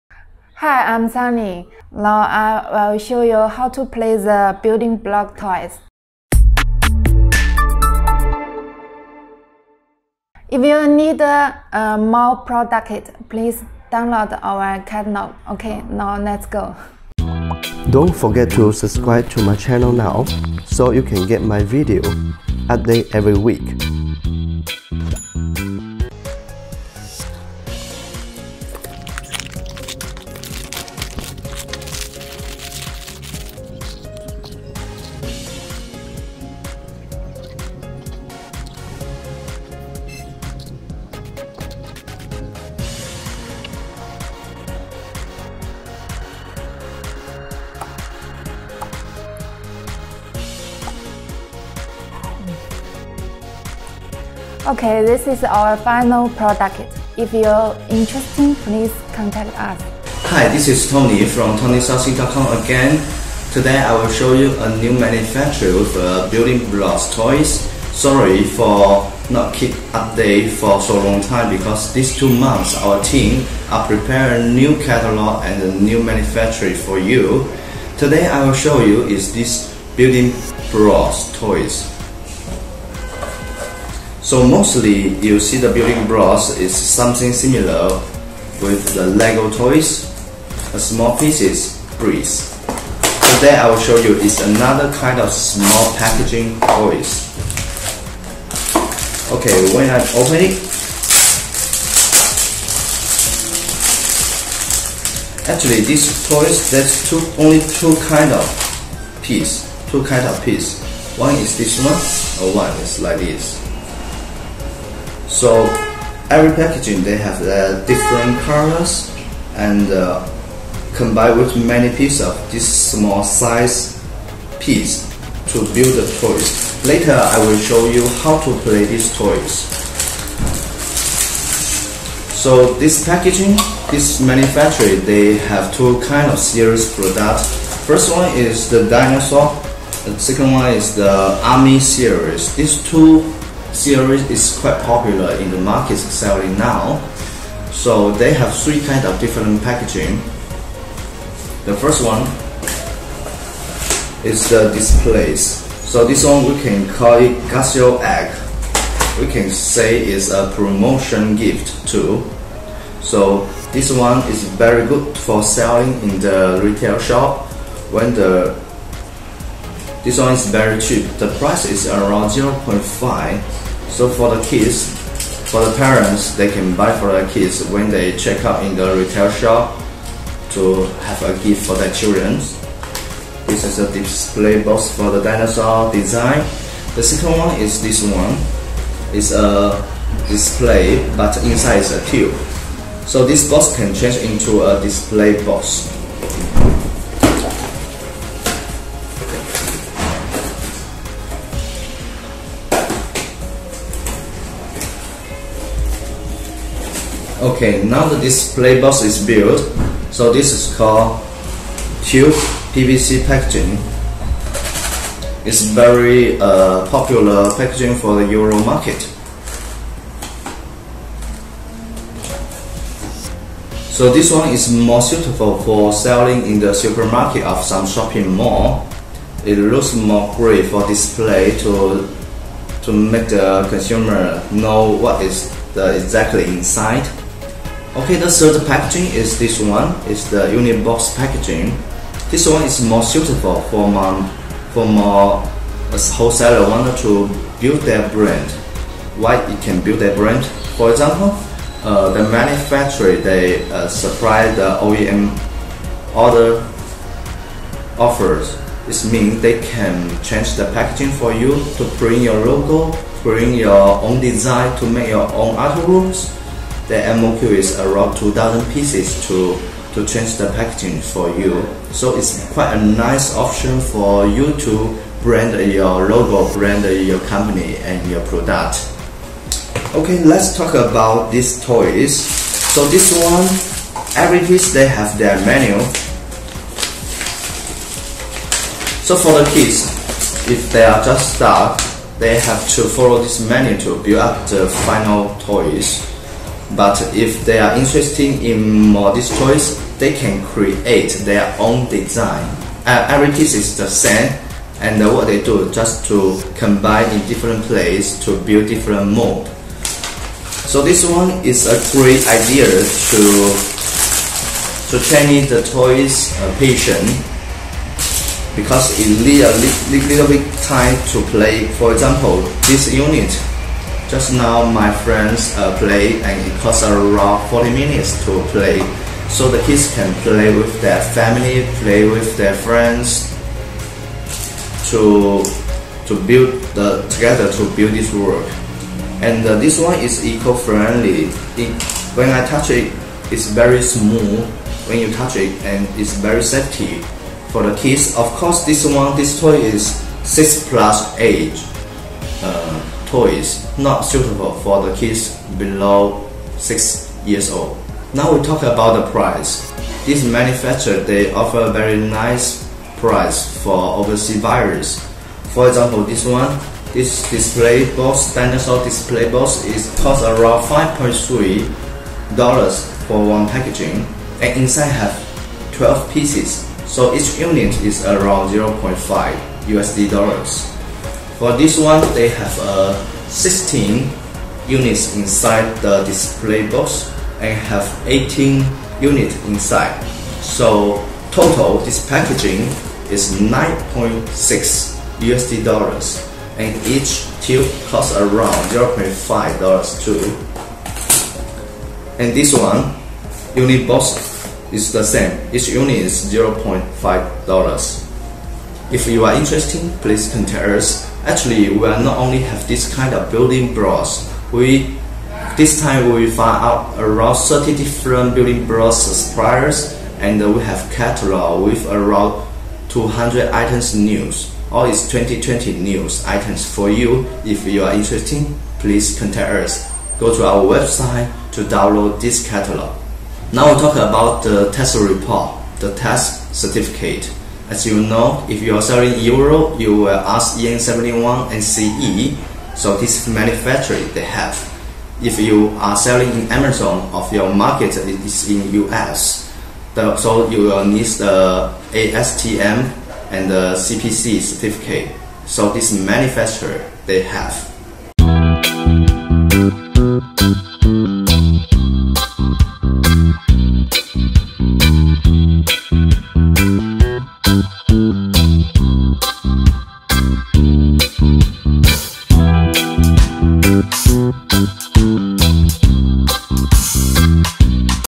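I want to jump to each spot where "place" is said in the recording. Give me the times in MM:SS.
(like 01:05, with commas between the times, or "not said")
05:07.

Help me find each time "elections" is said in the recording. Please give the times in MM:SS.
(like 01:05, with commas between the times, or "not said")
not said.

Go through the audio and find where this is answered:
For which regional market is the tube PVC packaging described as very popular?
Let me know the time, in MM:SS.
03:38.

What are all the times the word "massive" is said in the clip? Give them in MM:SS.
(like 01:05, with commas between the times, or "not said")
not said.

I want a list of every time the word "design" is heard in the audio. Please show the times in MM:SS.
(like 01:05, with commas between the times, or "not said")
03:05, 04:24, 05:01.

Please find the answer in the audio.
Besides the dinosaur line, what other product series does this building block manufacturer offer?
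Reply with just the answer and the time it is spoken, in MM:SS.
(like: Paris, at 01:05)
army series, at 02:21.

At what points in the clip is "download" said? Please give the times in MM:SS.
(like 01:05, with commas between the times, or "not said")
00:13, 07:11.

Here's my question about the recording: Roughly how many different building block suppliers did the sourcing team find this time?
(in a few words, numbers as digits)
30.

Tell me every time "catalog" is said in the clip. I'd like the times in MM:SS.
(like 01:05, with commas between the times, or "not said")
00:14, 01:14, 07:00, 07:12.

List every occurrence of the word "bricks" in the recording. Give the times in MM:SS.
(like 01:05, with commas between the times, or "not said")
01:31.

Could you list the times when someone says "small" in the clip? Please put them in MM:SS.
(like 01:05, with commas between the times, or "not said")
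01:30, 01:35, 02:02.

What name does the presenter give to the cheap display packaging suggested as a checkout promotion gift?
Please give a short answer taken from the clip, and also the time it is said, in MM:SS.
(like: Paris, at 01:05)
Casio Egg, at 02:37.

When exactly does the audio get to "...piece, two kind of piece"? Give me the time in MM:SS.
01:49.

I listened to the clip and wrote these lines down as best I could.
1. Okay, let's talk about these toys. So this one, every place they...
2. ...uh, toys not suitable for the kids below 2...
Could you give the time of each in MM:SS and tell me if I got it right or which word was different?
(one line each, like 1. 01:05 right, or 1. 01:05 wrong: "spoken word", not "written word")
1. 04:39 wrong: "piece", not "place"
2. 05:52 wrong: "6", not "2".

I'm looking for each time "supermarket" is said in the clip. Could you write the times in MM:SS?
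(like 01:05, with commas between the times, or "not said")
03:46.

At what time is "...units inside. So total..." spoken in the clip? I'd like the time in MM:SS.
06:28.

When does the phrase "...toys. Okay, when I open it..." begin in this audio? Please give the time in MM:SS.
01:36.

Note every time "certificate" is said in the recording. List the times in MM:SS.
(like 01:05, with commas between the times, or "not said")
07:16, 07:34.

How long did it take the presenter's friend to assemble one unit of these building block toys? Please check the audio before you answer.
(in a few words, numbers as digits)
40 minutes.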